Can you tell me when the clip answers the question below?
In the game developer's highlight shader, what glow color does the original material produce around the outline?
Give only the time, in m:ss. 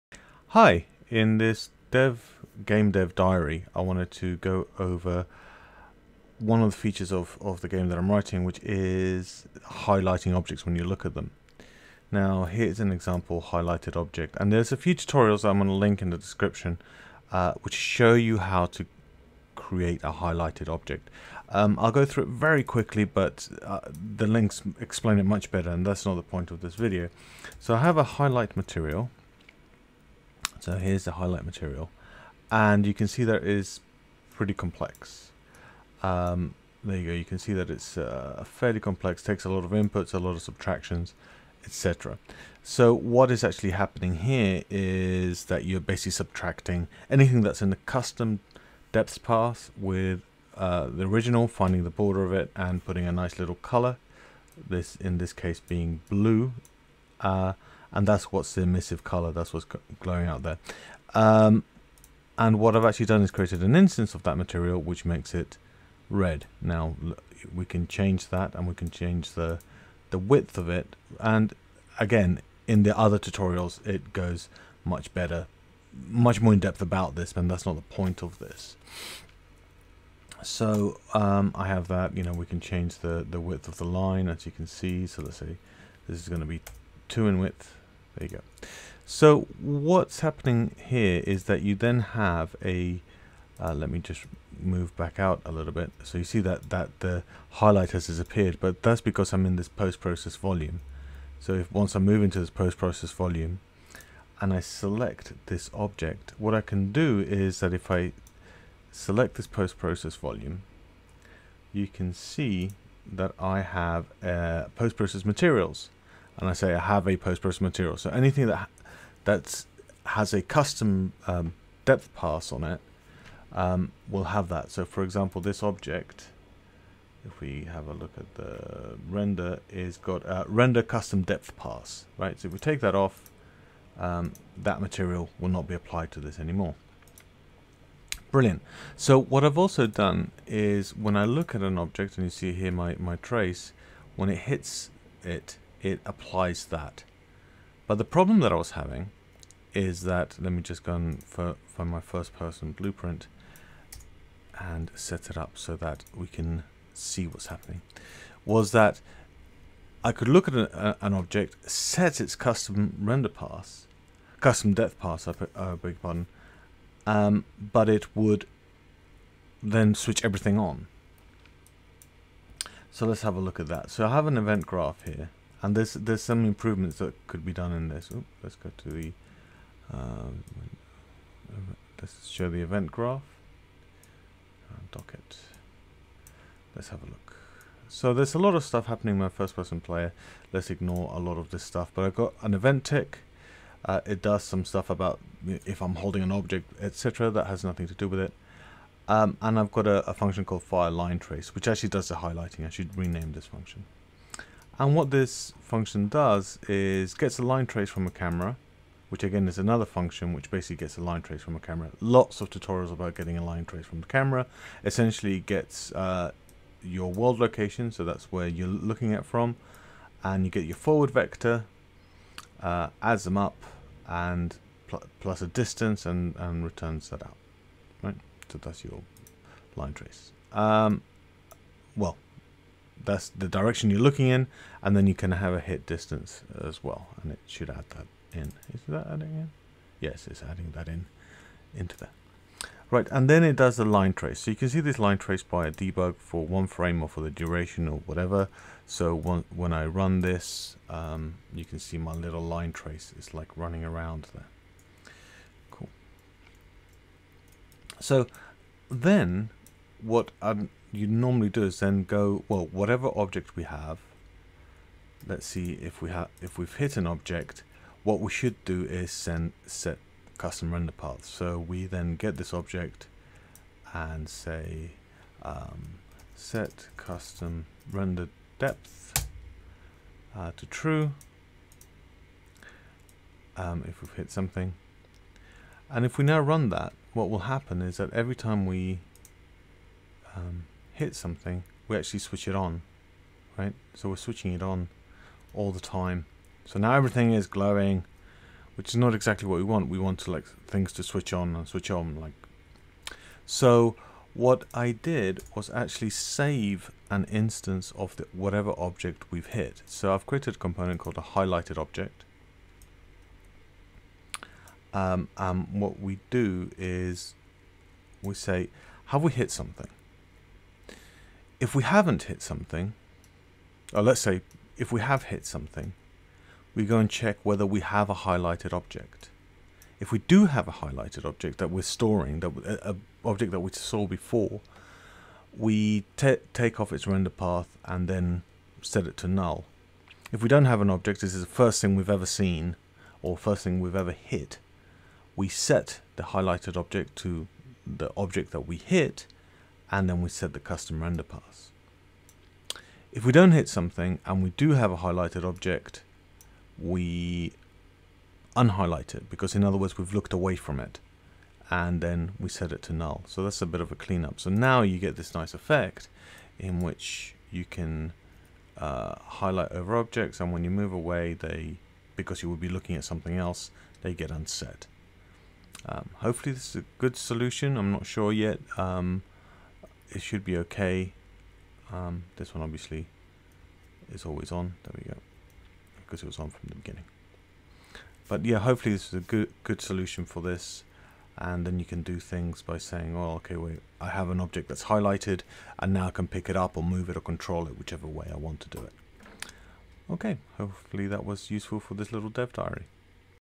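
0:56.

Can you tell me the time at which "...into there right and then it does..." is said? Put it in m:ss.
4:01.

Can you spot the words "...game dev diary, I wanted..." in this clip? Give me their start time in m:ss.
0:02.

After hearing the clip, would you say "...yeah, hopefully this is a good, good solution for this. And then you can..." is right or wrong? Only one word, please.
right.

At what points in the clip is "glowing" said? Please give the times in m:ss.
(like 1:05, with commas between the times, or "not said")
0:59, 4:57.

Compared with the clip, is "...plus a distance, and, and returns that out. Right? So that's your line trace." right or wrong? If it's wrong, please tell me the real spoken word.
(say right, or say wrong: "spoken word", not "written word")
right.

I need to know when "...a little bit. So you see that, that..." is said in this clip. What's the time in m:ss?
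1:35.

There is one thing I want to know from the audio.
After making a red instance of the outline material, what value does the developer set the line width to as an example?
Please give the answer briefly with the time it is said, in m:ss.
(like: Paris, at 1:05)
2, at 1:27.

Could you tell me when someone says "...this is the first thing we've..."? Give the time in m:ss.
5:41.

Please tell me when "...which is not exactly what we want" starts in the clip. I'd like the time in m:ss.
4:58.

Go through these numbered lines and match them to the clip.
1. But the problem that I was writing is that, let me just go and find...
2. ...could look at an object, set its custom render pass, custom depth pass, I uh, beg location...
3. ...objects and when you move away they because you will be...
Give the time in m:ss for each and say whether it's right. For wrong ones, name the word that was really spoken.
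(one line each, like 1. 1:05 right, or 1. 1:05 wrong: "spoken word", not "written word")
1. 2:27 wrong: "having", not "writing"
2. 2:40 wrong: "pardon", not "location"
3. 6:09 right.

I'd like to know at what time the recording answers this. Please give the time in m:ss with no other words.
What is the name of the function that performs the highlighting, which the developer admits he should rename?
3:20.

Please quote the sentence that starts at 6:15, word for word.
Um, hopefully this is a good solution.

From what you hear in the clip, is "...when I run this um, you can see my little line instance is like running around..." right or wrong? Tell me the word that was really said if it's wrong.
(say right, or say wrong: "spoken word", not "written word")
wrong: "trace", not "instance".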